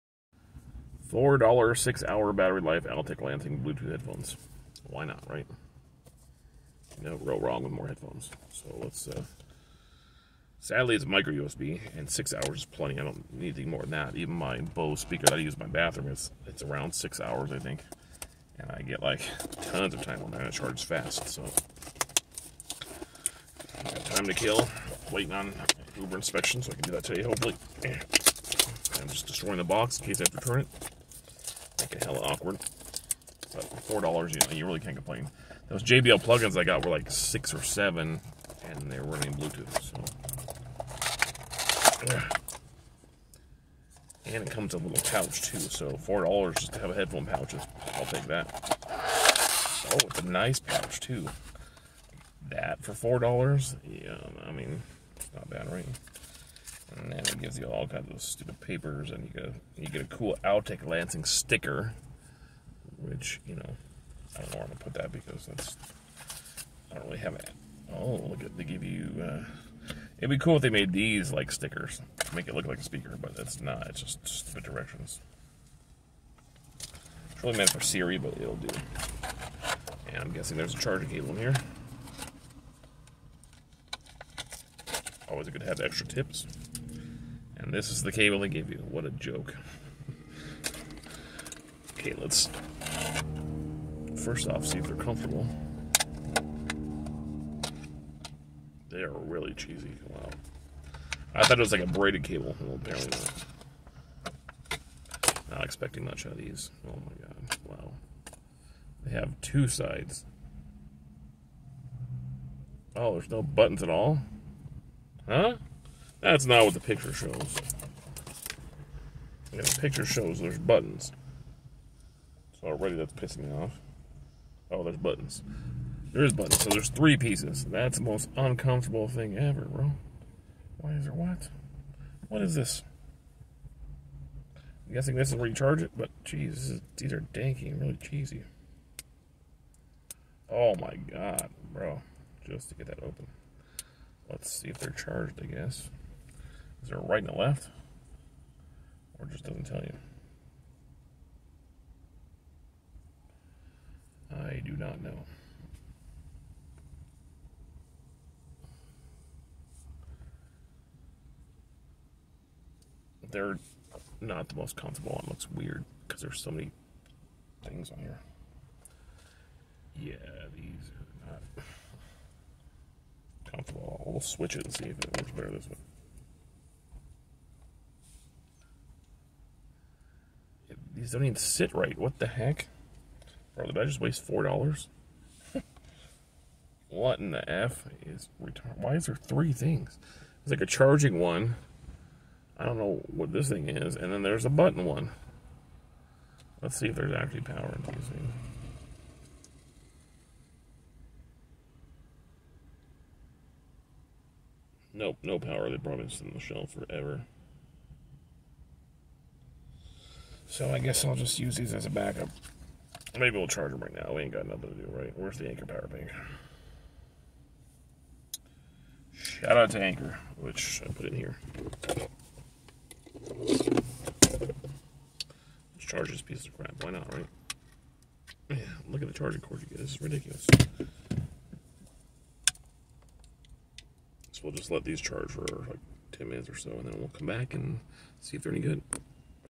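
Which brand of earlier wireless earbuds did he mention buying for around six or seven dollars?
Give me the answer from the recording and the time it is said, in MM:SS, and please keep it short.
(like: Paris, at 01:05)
JBL, at 00:35.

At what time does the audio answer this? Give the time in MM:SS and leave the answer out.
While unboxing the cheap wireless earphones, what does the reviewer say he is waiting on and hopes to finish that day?
00:25.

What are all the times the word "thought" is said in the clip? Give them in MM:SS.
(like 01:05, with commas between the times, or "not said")
01:41.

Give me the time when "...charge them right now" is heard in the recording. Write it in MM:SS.
03:33.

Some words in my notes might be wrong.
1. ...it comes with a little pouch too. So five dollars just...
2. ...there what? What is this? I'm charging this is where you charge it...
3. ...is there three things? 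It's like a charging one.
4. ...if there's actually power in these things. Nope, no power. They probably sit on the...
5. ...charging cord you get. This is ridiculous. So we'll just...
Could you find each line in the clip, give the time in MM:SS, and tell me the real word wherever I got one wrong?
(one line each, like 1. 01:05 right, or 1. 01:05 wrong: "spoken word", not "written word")
1. 00:44 wrong: "four", not "five"
2. 02:11 wrong: "guessing", not "charging"
3. 03:08 right
4. 03:16 right
5. 03:49 right.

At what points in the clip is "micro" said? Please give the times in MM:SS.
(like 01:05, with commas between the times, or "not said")
00:11.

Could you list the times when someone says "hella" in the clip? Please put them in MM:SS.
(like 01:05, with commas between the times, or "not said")
00:32.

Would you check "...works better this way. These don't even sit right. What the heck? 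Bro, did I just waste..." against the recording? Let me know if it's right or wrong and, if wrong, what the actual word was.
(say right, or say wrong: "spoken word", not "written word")
right.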